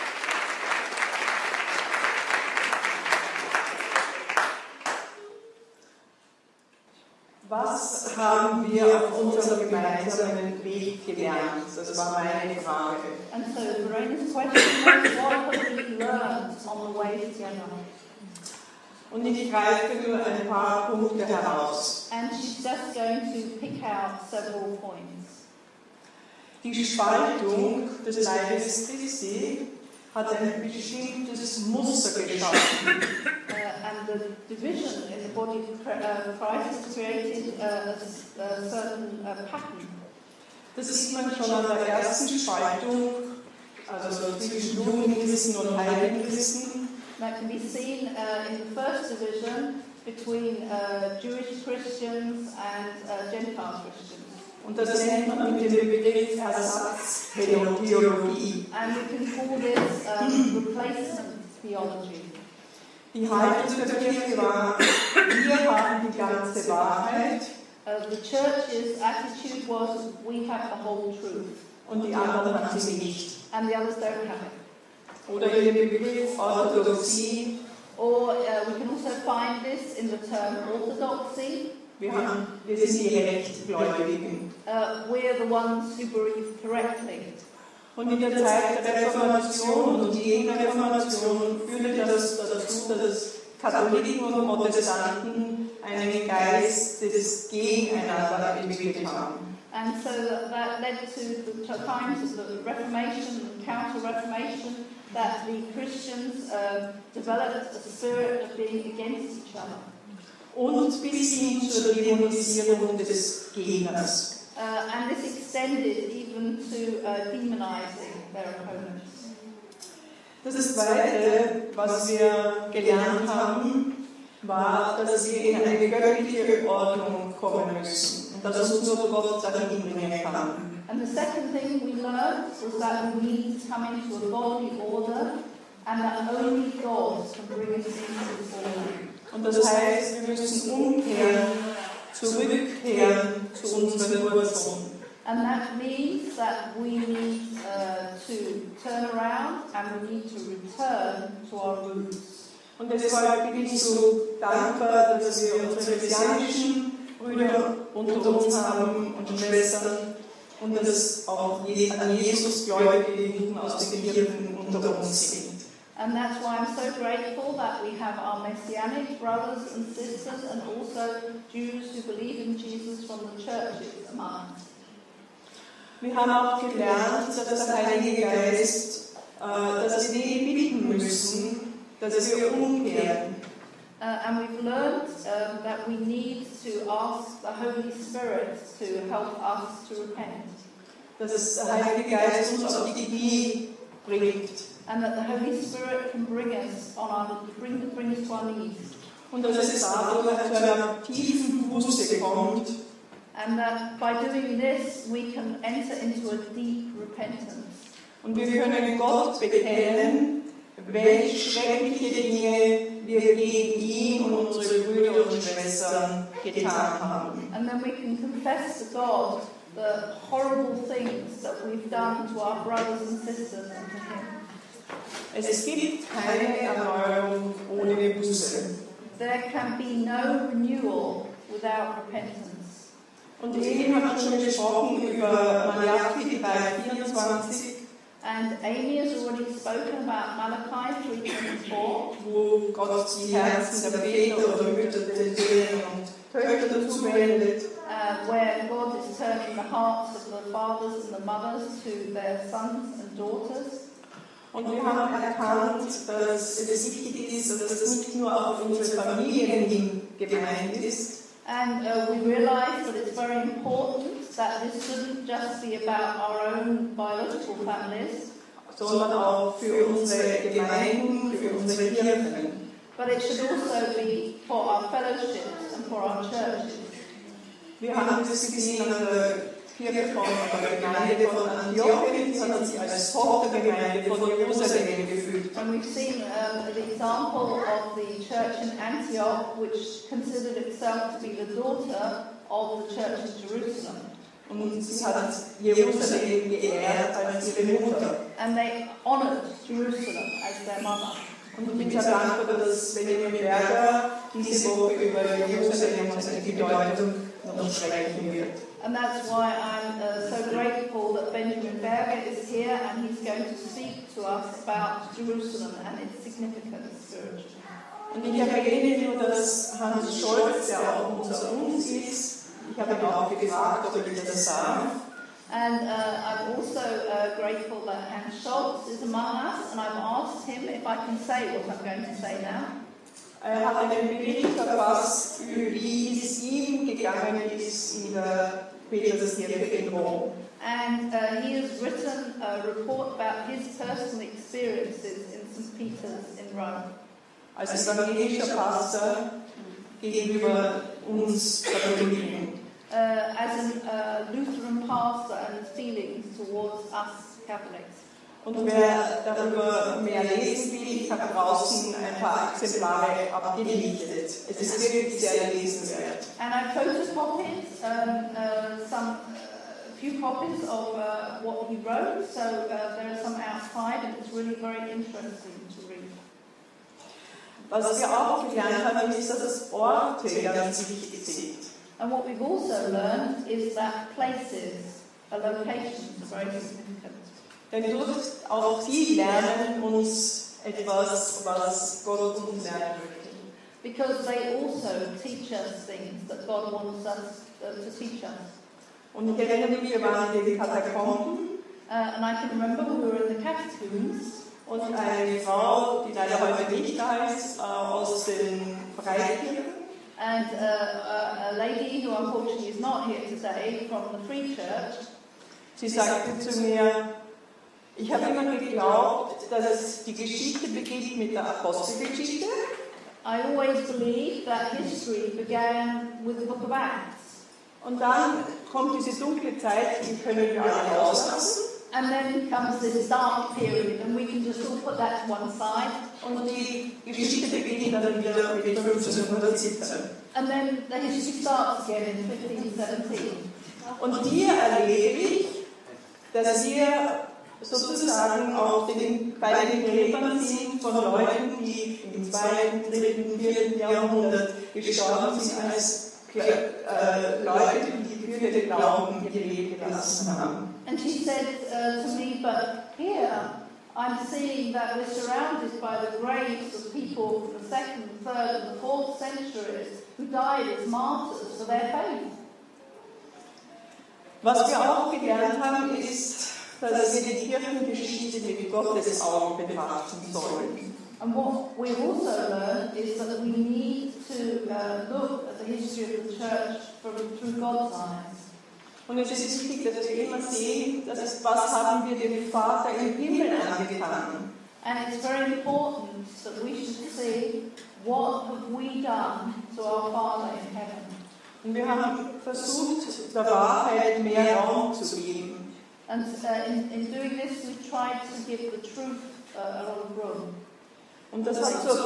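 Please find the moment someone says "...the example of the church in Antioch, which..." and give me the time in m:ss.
4:46.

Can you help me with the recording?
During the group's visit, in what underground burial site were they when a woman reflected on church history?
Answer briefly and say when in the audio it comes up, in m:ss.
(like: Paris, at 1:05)
The catacombs, at 6:43.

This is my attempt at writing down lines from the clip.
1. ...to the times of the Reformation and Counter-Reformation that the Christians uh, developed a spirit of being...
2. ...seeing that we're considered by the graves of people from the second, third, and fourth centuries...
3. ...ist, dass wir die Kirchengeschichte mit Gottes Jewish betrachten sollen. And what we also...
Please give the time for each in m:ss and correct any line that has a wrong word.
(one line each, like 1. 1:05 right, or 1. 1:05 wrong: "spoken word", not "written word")
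1. 1:41 right
2. 7:44 wrong: "surrounded", not "considered"
3. 7:55 wrong: "Augen", not "Jewish".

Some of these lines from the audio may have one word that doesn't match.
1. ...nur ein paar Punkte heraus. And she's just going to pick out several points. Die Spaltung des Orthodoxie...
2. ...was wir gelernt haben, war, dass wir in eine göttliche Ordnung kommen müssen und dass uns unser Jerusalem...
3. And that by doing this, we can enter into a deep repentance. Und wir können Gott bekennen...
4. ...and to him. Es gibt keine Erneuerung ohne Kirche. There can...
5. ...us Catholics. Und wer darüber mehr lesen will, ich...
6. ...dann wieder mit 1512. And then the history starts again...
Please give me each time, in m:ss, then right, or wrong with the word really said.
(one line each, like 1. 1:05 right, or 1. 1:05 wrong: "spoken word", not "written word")
1. 0:20 wrong: "Leibes", not "Orthodoxie"
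2. 2:01 wrong: "Gott", not "Jerusalem"
3. 3:23 right
4. 3:43 wrong: "Buße", not "Kirche"
5. 5:56 right
6. 7:17 wrong: "1517", not "1512".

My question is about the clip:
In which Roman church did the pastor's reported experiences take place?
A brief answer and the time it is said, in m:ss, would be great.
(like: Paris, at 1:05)
St. Peter's, at 5:45.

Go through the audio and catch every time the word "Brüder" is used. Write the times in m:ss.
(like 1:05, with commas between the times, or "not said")
2:37, 3:34.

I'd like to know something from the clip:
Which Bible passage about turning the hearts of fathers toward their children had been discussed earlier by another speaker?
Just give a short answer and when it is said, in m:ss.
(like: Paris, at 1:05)
Malachi 3:24, at 4:00.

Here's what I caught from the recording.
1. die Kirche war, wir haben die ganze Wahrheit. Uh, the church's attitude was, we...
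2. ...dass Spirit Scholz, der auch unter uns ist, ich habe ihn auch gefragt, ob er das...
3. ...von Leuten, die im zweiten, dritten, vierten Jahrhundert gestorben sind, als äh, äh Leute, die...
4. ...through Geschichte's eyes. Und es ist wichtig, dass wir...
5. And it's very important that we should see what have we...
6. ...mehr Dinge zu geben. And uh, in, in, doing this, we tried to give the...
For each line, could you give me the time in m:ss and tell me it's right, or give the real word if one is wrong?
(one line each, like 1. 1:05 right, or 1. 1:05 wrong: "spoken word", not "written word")
1. 1:03 right
2. 5:19 wrong: "Hans", not "Spirit"
3. 7:30 right
4. 8:07 wrong: "God", not "Geschichte"
5. 8:14 right
6. 8:24 wrong: "Raum", not "Dinge".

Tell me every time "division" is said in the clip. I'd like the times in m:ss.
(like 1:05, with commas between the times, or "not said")
0:34, 0:49.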